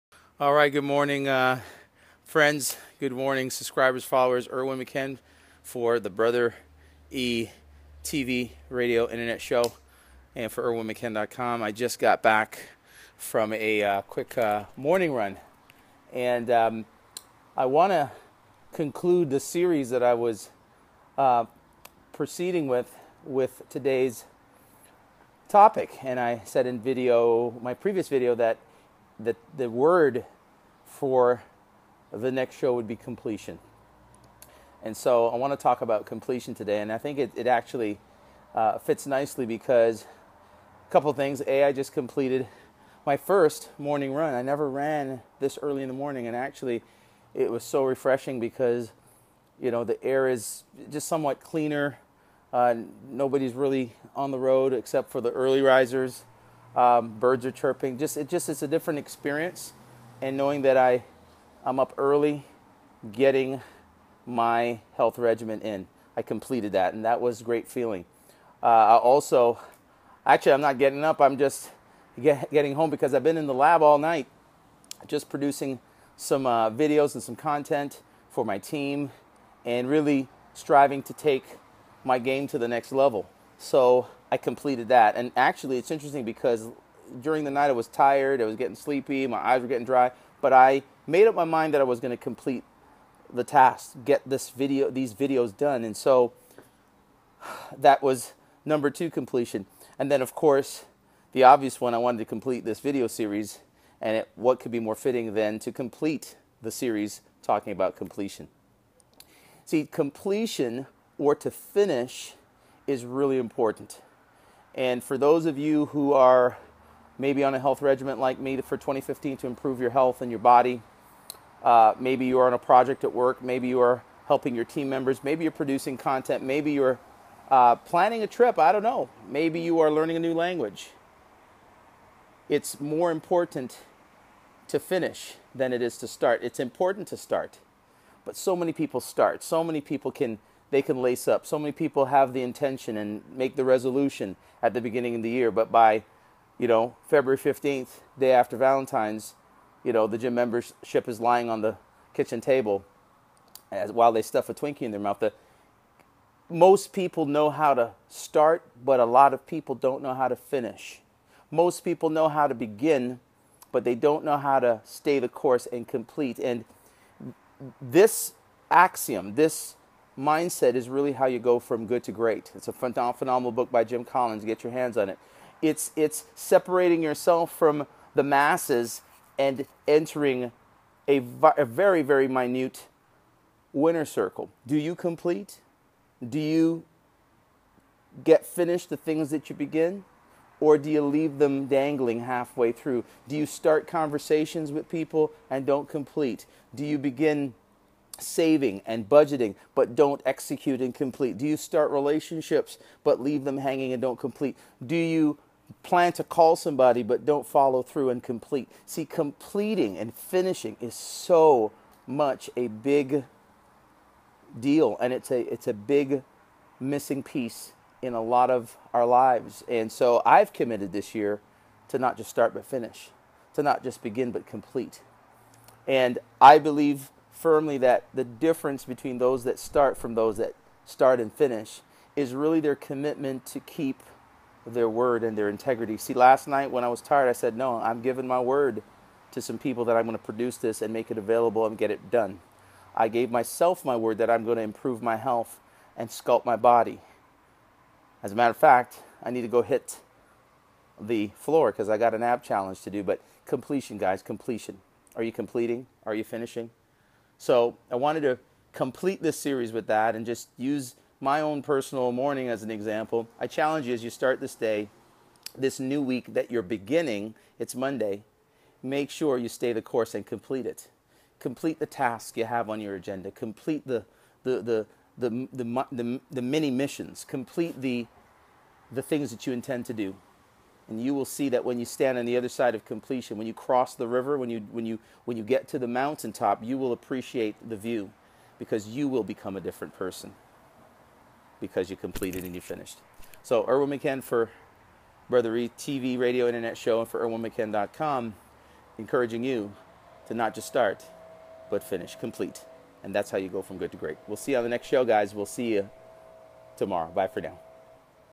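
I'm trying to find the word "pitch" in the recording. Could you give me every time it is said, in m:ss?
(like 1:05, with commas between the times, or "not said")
not said.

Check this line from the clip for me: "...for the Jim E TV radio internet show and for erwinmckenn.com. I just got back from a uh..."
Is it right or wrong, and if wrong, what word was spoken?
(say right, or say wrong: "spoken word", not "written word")
wrong: "Brother", not "Jim".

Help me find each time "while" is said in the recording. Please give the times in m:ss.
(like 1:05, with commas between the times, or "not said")
2:33.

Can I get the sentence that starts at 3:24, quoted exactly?
Do you plan to call somebody but don't follow through and complete?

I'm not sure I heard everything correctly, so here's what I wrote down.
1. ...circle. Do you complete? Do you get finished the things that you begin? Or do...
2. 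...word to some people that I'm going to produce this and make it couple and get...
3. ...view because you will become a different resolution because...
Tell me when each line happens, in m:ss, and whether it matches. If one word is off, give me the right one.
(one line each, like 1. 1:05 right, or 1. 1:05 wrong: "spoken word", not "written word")
1. 3:04 right
2. 3:58 wrong: "available", not "couple"
3. 4:47 wrong: "person", not "resolution".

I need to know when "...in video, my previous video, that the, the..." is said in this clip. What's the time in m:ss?
0:26.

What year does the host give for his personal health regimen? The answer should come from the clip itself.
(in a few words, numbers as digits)
2015.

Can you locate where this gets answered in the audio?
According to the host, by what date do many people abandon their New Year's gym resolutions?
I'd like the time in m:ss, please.
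2:27.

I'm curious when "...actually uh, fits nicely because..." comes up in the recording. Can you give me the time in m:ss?
0:37.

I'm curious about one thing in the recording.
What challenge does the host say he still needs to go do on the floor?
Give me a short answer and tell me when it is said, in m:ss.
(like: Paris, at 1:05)
App challenge, at 4:12.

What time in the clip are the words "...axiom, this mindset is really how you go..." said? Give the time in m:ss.
2:48.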